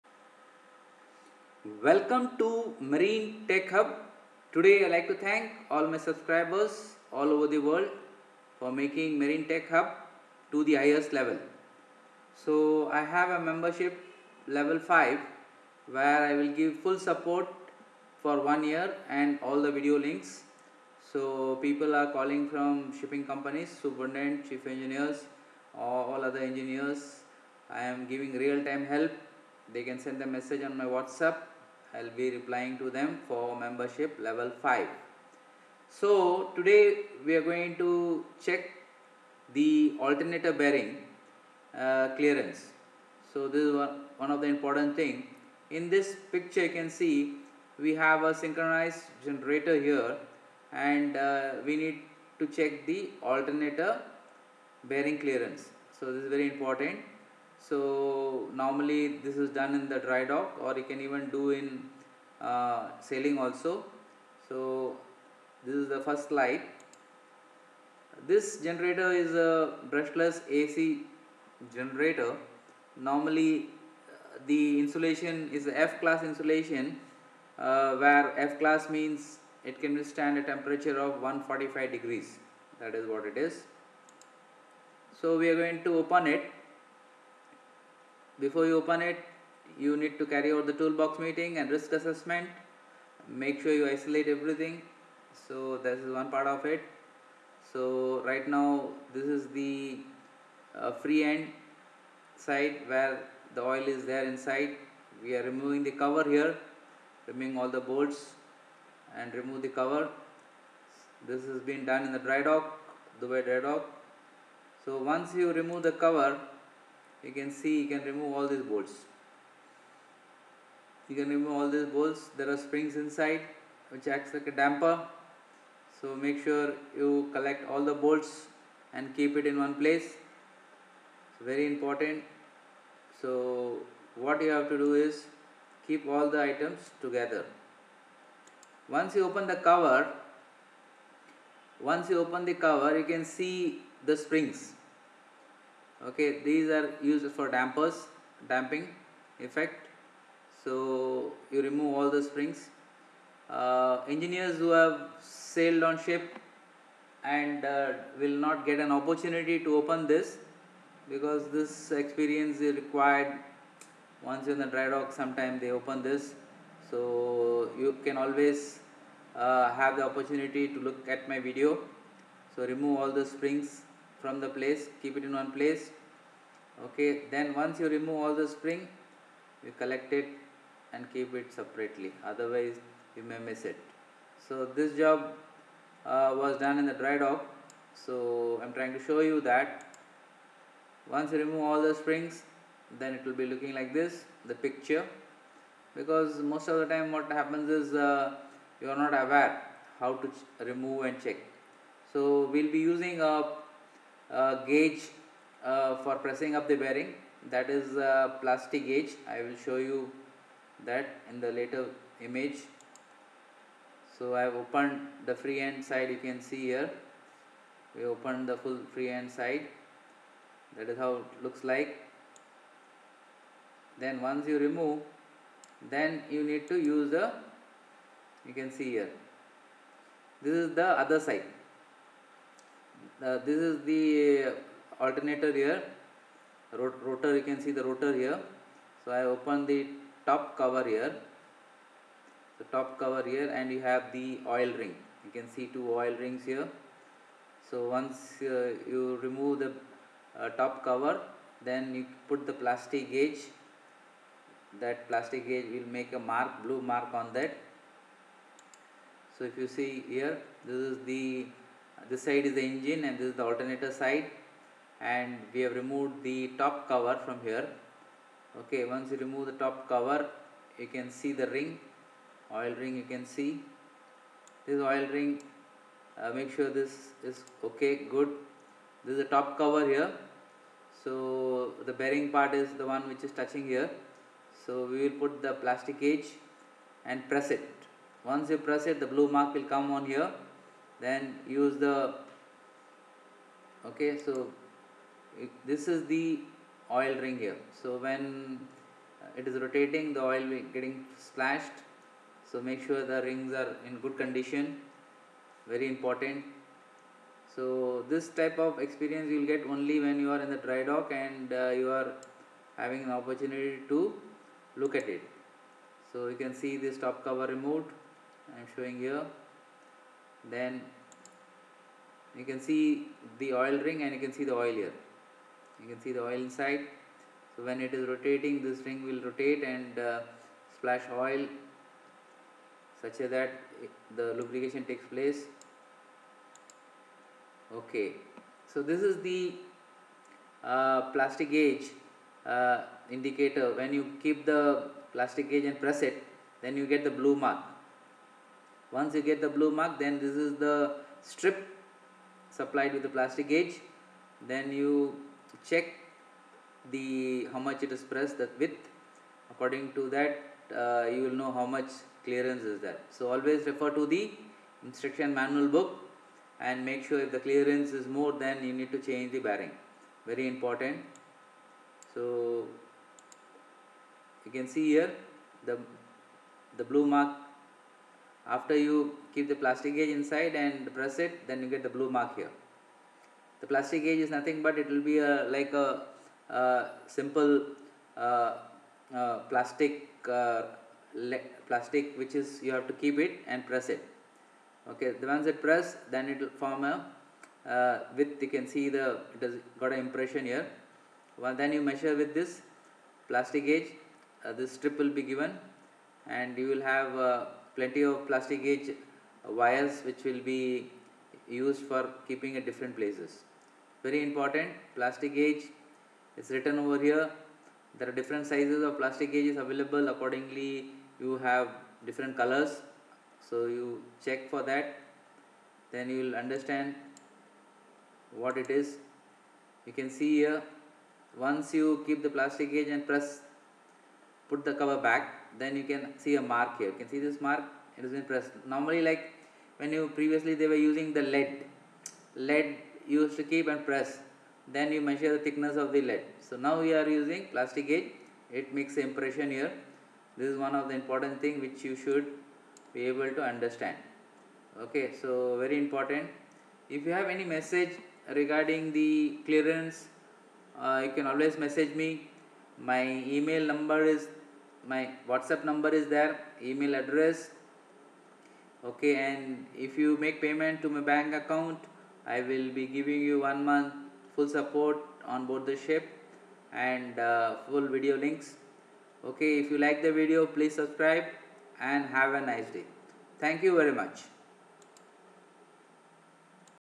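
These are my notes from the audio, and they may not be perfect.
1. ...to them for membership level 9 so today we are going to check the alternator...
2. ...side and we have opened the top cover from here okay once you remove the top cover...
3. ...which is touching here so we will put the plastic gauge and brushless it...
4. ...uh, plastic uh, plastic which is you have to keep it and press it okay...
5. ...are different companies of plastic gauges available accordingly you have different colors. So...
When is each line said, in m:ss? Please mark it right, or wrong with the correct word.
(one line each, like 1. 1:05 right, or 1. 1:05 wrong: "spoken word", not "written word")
1. 0:32 wrong: "5", not "9"
2. 4:23 wrong: "removed", not "opened"
3. 4:43 wrong: "press", not "brushless"
4. 6:29 right
5. 6:58 wrong: "sizes", not "companies".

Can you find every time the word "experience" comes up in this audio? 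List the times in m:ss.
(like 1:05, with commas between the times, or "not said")
2:41, 5:08.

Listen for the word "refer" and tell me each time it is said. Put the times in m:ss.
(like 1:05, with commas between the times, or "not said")
6:03.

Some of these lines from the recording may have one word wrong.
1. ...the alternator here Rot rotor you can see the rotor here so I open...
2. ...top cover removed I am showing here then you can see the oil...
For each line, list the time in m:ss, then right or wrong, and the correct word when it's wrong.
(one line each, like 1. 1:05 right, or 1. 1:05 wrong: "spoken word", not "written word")
1. 3:53 right
2. 5:16 right.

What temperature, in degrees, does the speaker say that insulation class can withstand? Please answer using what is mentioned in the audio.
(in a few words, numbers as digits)
145.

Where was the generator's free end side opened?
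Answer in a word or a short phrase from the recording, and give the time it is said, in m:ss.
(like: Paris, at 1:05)
Dubai dry dock, at 1:53.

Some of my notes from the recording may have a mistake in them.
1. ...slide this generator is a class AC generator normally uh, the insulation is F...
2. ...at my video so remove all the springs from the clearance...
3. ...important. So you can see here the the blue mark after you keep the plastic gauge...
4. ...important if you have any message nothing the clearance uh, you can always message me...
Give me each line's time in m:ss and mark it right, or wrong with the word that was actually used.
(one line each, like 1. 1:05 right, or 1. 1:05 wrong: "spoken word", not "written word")
1. 1:06 wrong: "brushless", not "class"
2. 2:51 wrong: "place", not "clearance"
3. 6:10 right
4. 7:35 wrong: "regarding", not "nothing".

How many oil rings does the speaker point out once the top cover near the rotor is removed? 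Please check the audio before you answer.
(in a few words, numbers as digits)
2.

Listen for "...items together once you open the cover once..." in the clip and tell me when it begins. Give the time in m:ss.
2:16.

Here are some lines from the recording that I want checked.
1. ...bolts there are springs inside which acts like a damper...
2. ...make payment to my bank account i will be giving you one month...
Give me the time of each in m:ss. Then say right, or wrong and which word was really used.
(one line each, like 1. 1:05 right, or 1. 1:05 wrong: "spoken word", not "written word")
1. 2:01 right
2. 7:50 right.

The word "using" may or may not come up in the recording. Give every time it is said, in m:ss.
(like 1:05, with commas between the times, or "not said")
3:22, 7:20, 7:27.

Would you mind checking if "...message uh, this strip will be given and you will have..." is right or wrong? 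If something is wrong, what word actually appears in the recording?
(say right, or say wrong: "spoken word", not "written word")
wrong: "gauge", not "message".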